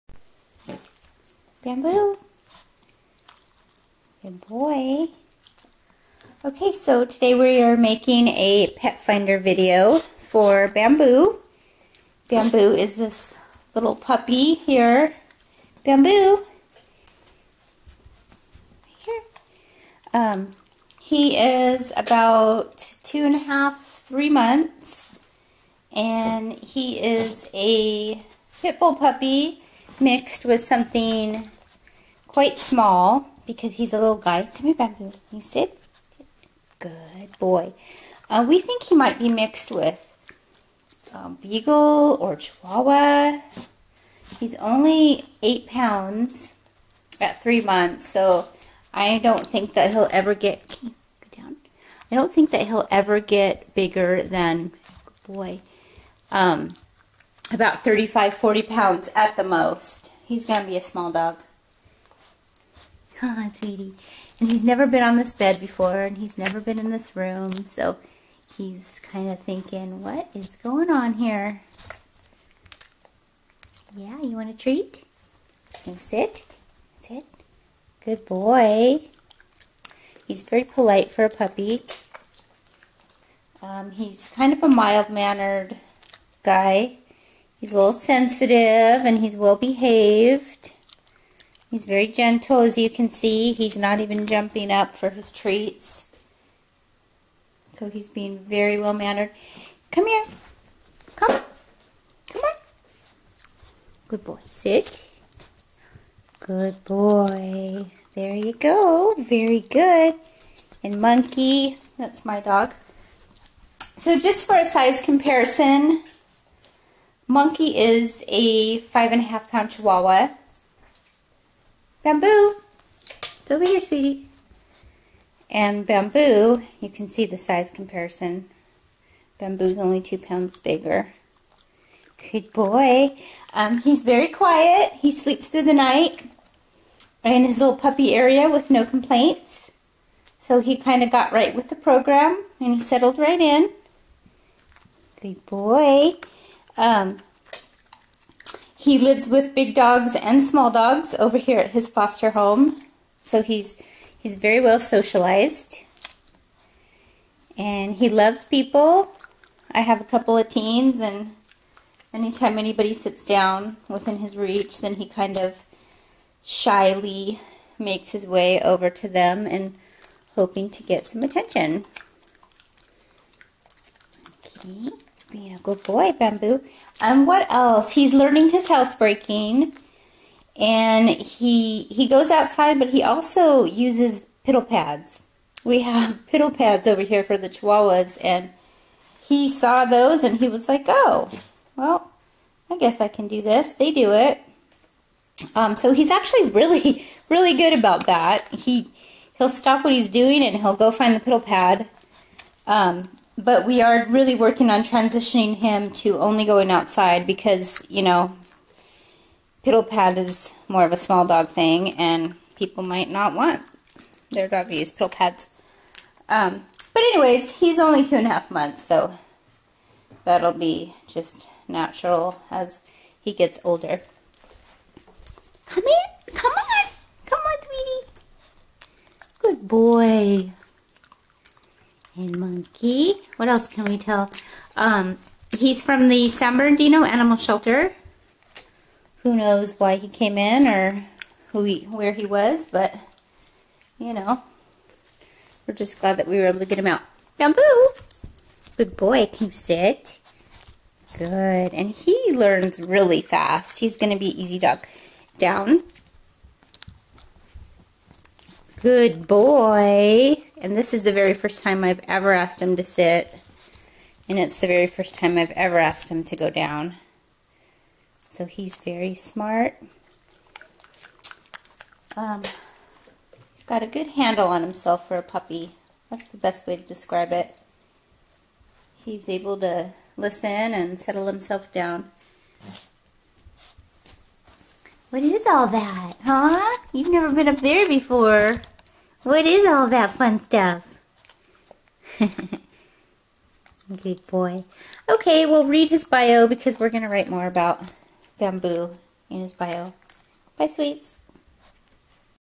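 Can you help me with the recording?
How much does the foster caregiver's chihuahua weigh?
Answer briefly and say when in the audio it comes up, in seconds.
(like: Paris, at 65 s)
5.5 pounds, at 118 s.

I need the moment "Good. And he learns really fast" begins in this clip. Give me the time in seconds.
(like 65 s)
251 s.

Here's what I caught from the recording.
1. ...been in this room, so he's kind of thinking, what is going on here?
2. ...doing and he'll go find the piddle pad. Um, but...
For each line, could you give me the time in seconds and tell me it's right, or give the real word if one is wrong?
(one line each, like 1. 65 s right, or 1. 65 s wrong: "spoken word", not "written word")
1. 66 s right
2. 200 s right.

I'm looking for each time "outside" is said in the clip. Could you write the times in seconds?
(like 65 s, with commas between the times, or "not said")
182 s, 206 s.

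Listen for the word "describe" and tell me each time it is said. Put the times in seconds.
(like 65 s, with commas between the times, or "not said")
276 s.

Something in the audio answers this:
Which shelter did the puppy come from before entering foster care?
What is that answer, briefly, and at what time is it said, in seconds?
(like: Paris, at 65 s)
San Bernardino Animal Shelter, at 236 s.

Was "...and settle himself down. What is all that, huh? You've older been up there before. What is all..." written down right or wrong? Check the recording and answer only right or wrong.
wrong.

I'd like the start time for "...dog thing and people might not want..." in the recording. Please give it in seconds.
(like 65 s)
211 s.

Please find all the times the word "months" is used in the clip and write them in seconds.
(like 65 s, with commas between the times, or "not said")
24 s, 47 s, 218 s.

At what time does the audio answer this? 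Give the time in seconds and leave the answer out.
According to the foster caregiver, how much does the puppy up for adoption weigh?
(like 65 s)
45 s.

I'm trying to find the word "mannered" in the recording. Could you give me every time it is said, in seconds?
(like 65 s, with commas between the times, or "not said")
84 s, 98 s.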